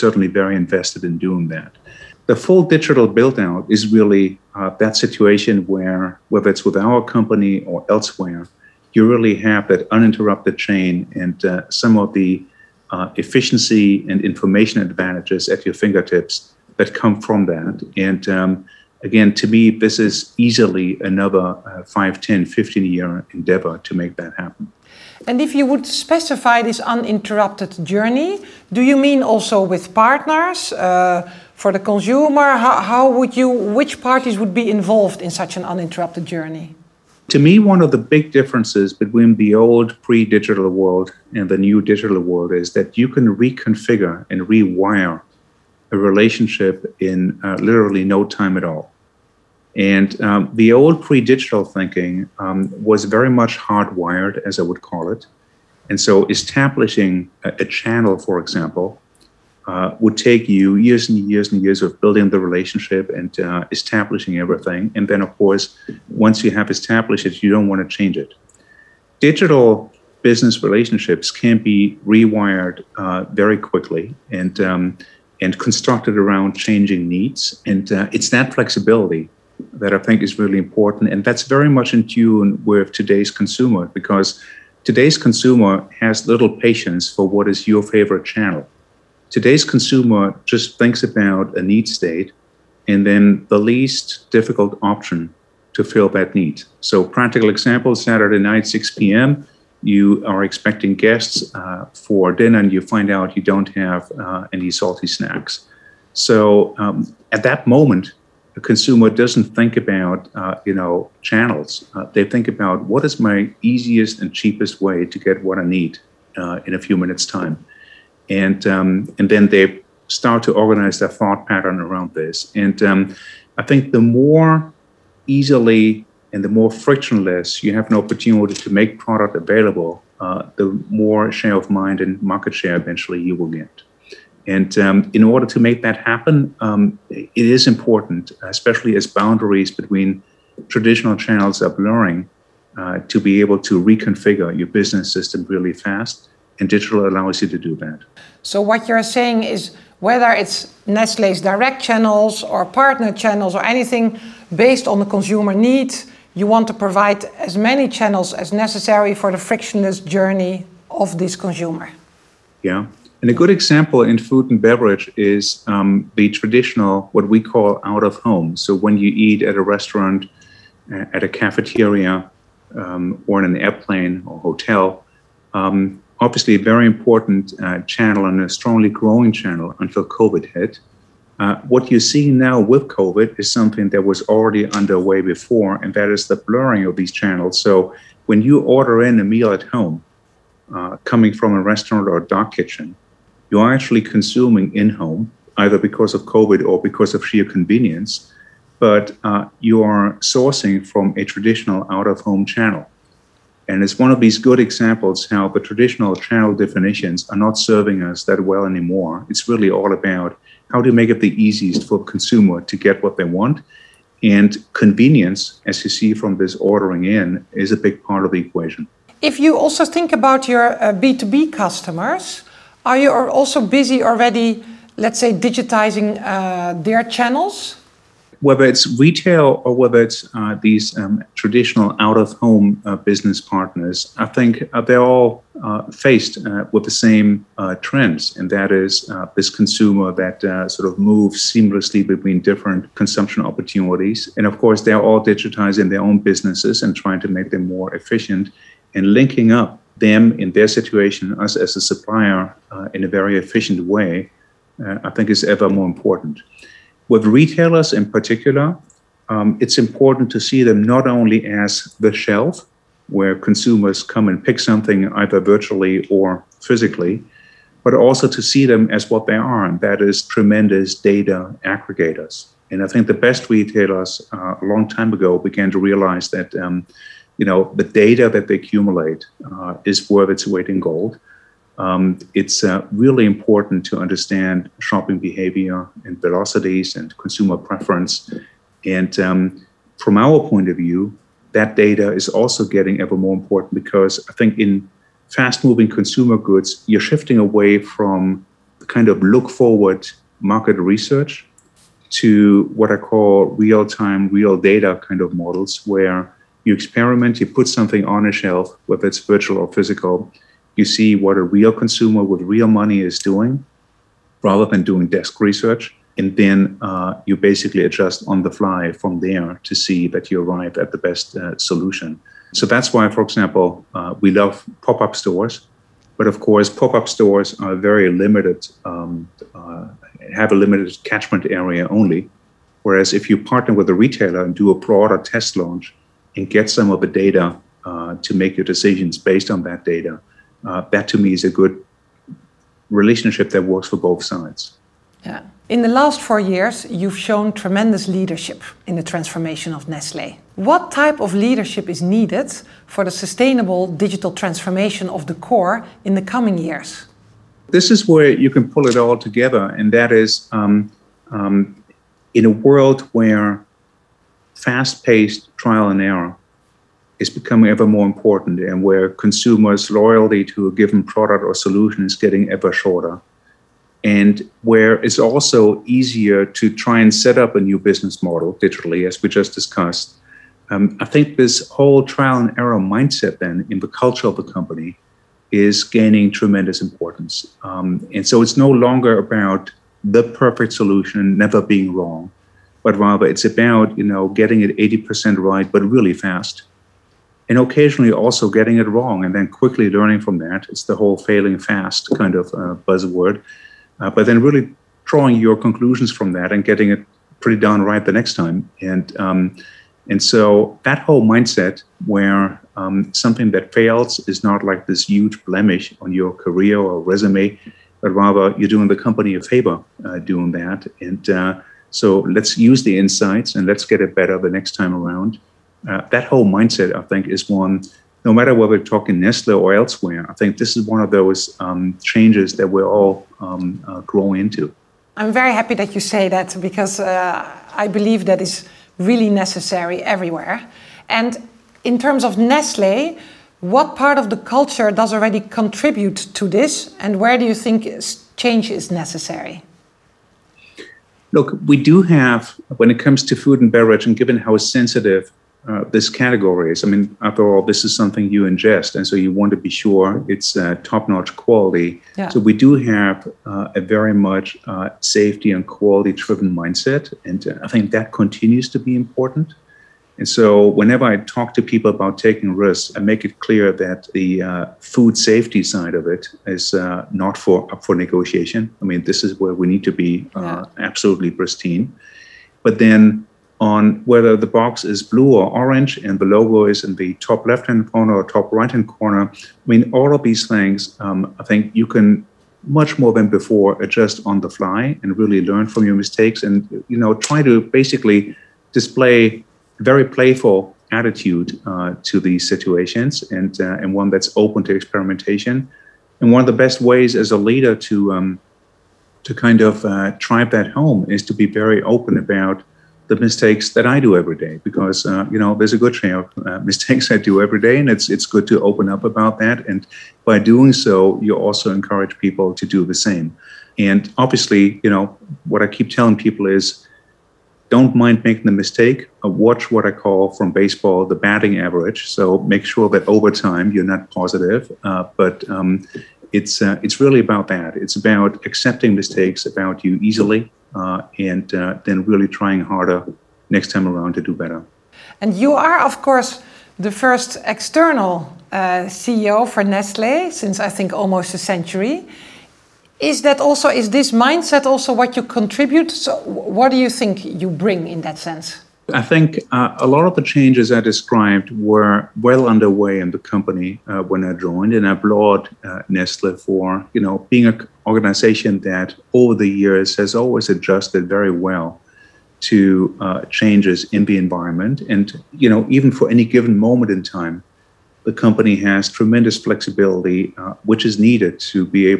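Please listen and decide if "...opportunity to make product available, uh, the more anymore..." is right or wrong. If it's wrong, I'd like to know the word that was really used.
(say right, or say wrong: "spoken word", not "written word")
wrong: "share", not "anymore".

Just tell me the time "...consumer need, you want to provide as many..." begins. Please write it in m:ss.
2:35.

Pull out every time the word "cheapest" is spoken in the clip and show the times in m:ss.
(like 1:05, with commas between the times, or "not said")
1:54.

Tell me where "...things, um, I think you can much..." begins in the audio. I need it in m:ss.
8:10.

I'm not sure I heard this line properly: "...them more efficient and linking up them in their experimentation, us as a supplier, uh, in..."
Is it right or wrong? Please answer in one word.
wrong.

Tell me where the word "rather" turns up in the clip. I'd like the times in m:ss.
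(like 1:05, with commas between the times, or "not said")
5:14, 6:32, 6:58.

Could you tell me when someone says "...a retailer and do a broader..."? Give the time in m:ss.
5:33.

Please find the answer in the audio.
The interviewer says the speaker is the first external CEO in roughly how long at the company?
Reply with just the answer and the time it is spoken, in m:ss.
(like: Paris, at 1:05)
almost a century, at 9:10.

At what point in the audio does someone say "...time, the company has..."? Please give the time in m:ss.
9:37.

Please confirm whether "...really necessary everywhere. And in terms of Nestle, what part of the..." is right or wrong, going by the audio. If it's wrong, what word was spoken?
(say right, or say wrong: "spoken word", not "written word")
right.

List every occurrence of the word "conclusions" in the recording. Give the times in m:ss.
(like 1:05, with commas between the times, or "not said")
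6:45.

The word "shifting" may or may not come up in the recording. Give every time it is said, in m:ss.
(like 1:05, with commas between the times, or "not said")
4:57.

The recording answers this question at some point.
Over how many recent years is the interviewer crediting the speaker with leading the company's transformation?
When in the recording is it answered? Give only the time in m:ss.
5:46.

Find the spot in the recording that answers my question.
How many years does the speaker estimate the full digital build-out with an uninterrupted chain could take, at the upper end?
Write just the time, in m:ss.
0:22.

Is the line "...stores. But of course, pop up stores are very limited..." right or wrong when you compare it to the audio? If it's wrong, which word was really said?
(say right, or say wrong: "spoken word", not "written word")
right.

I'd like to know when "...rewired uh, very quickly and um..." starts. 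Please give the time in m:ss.
1:12.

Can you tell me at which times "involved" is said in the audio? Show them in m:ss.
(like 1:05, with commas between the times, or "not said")
0:34.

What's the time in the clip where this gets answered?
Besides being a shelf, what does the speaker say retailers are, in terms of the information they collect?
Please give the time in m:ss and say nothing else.
4:30.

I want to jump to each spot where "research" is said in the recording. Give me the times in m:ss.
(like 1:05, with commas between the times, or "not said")
5:00, 5:15.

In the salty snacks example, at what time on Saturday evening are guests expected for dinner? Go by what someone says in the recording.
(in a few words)
6 p.m.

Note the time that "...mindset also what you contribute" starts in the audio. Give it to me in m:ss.
9:14.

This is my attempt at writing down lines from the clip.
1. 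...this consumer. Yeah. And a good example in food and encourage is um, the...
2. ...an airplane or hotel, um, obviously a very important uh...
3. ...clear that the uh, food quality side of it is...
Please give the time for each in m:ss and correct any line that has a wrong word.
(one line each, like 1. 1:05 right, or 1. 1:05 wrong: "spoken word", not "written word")
1. 2:41 wrong: "beverage", not "encourage"
2. 2:53 right
3. 7:53 wrong: "safety", not "quality".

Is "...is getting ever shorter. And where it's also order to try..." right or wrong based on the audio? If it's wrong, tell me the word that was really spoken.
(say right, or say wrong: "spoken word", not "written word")
wrong: "easier", not "order".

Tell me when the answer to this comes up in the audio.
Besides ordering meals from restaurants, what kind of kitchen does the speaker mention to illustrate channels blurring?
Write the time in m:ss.
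3:12.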